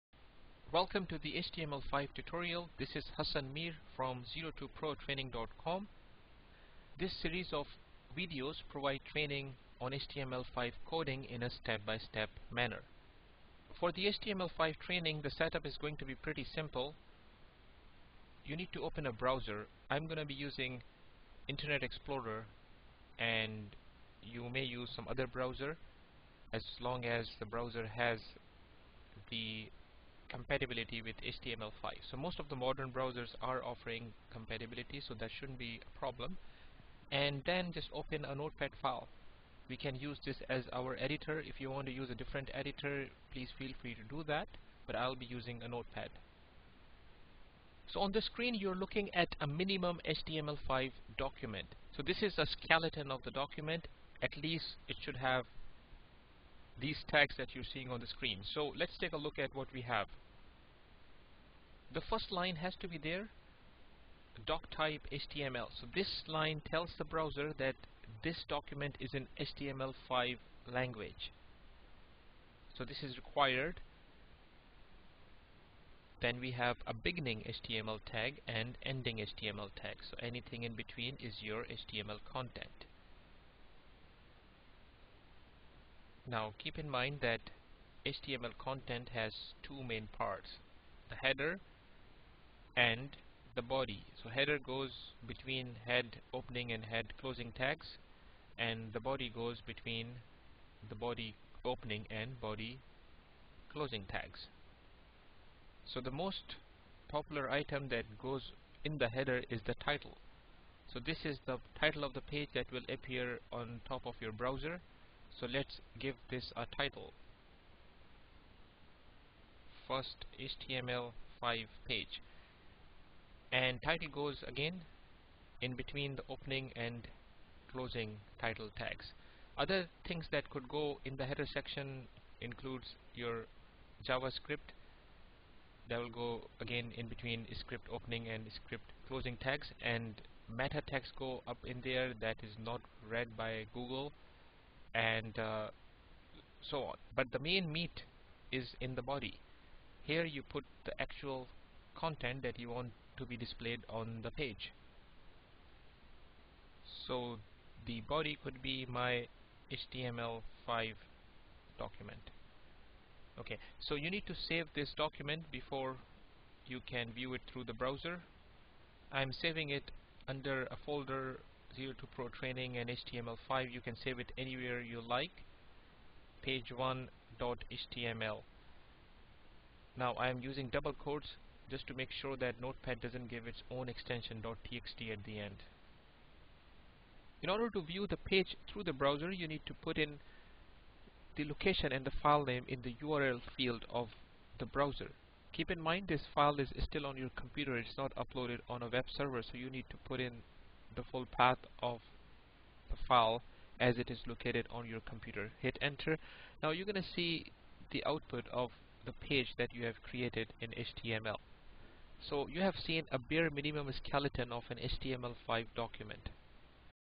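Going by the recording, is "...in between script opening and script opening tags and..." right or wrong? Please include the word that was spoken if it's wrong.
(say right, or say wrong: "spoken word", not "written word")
wrong: "closing", not "opening".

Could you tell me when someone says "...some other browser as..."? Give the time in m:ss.
0:24.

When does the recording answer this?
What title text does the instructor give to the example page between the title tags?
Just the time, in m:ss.
1:59.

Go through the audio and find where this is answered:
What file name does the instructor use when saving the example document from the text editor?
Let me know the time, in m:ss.
2:56.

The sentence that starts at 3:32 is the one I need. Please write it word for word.
So you have seen a bare minimum skeleton of an HTML5 document.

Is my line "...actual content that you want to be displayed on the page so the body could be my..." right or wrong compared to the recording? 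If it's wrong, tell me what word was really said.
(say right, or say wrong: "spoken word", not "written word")
right.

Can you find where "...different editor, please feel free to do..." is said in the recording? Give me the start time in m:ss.
0:42.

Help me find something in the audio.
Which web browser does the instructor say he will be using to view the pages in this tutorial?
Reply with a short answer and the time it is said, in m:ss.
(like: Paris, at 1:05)
Internet Explorer, at 0:21.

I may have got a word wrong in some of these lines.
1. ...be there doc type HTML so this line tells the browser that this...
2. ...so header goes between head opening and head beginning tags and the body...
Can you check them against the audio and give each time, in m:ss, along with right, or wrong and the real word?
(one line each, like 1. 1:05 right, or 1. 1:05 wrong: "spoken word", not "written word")
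1. 1:02 right
2. 1:34 wrong: "closing", not "beginning".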